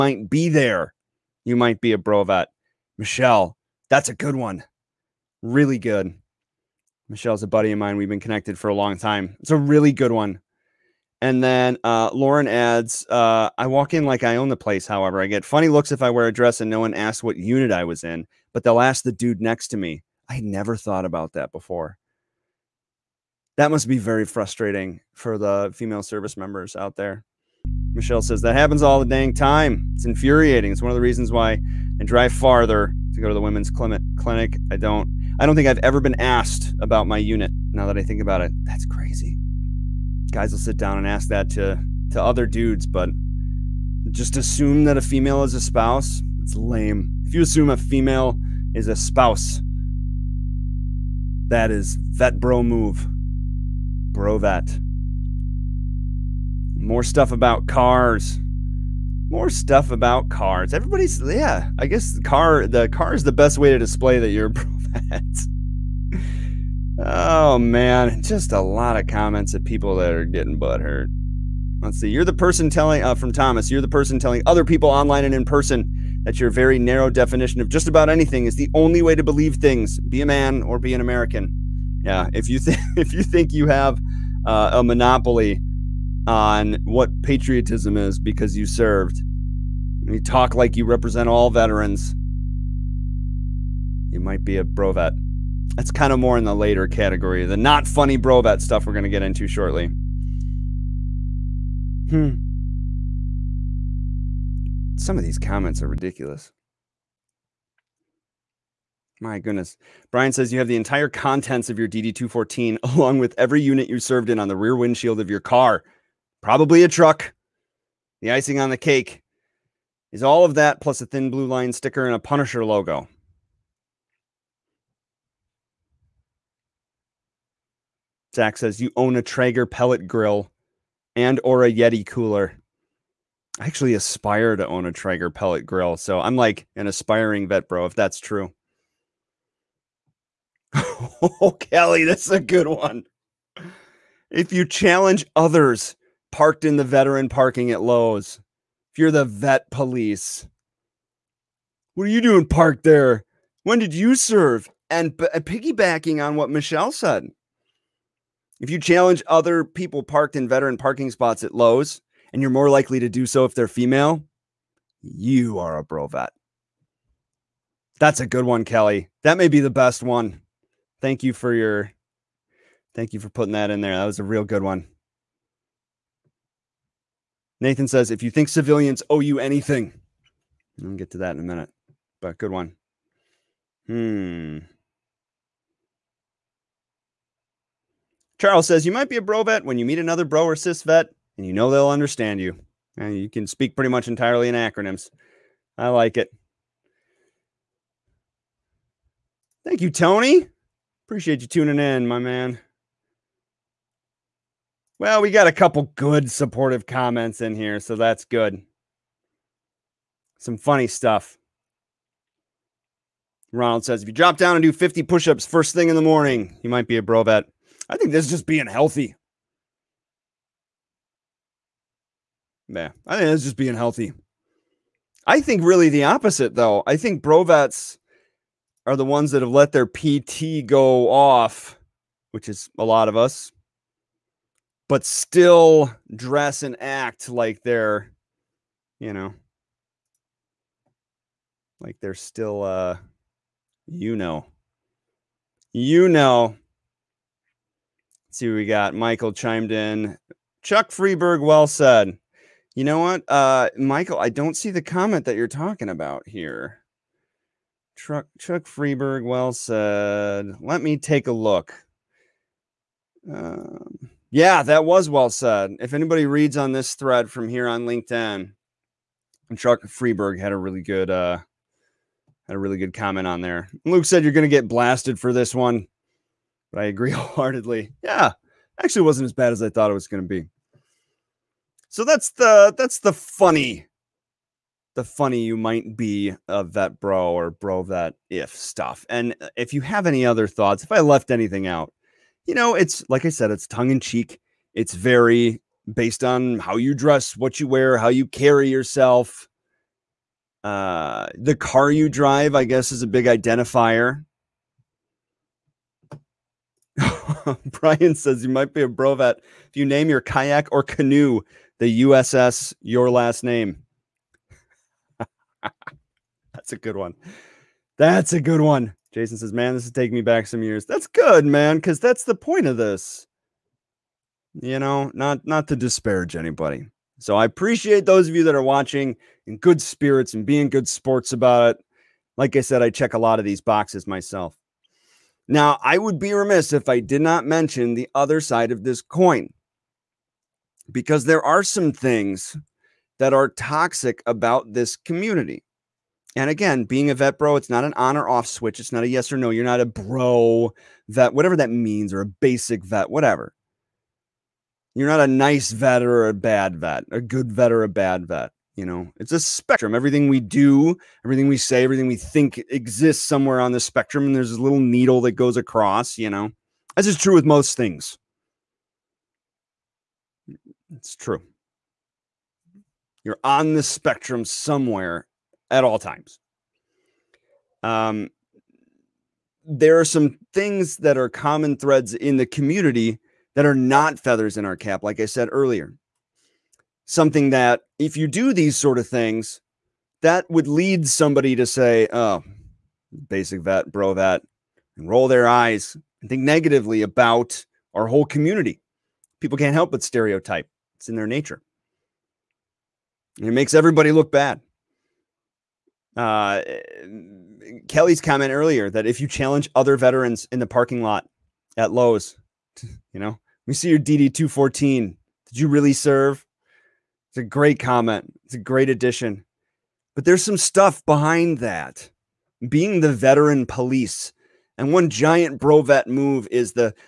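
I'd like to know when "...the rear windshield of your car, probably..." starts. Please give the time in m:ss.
1:54.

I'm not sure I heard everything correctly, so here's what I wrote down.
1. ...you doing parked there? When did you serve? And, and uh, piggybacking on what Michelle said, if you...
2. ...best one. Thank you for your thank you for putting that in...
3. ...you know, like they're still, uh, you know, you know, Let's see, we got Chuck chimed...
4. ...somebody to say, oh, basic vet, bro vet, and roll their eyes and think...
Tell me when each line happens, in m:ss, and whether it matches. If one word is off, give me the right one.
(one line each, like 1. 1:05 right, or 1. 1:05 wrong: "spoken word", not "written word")
1. 2:32 right
2. 2:49 right
3. 3:58 wrong: "Michael", not "Chuck"
4. 6:31 right.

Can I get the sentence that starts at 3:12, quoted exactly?
And you can speak pretty much entirely in acronyms.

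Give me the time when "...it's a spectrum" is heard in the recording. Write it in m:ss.
5:59.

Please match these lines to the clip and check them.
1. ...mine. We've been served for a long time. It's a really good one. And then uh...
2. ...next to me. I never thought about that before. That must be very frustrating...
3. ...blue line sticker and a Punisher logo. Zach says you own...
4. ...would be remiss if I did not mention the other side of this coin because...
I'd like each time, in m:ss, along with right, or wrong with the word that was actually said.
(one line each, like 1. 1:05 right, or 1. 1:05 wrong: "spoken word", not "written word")
1. 0:07 wrong: "connected", not "served"
2. 0:19 right
3. 2:01 right
4. 5:35 right.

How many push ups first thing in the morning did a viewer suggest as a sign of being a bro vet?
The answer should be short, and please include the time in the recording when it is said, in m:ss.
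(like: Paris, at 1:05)
50, at 3:34.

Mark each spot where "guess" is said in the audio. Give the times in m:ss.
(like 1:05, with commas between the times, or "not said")
1:01, 5:02.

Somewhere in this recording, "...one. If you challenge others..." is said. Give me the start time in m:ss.
2:22.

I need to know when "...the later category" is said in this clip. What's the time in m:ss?
1:36.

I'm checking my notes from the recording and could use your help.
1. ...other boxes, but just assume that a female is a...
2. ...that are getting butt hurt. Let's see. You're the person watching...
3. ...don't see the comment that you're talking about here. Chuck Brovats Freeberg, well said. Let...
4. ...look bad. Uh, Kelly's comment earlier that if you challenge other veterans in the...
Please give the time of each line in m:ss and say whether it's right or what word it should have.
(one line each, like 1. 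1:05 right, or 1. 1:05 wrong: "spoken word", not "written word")
1. 0:42 wrong: "dudes", not "boxes"
2. 1:09 wrong: "telling", not "watching"
3. 4:14 wrong: "Chuck", not "Brovats"
4. 6:44 right.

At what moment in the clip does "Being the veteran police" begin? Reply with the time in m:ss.
7:02.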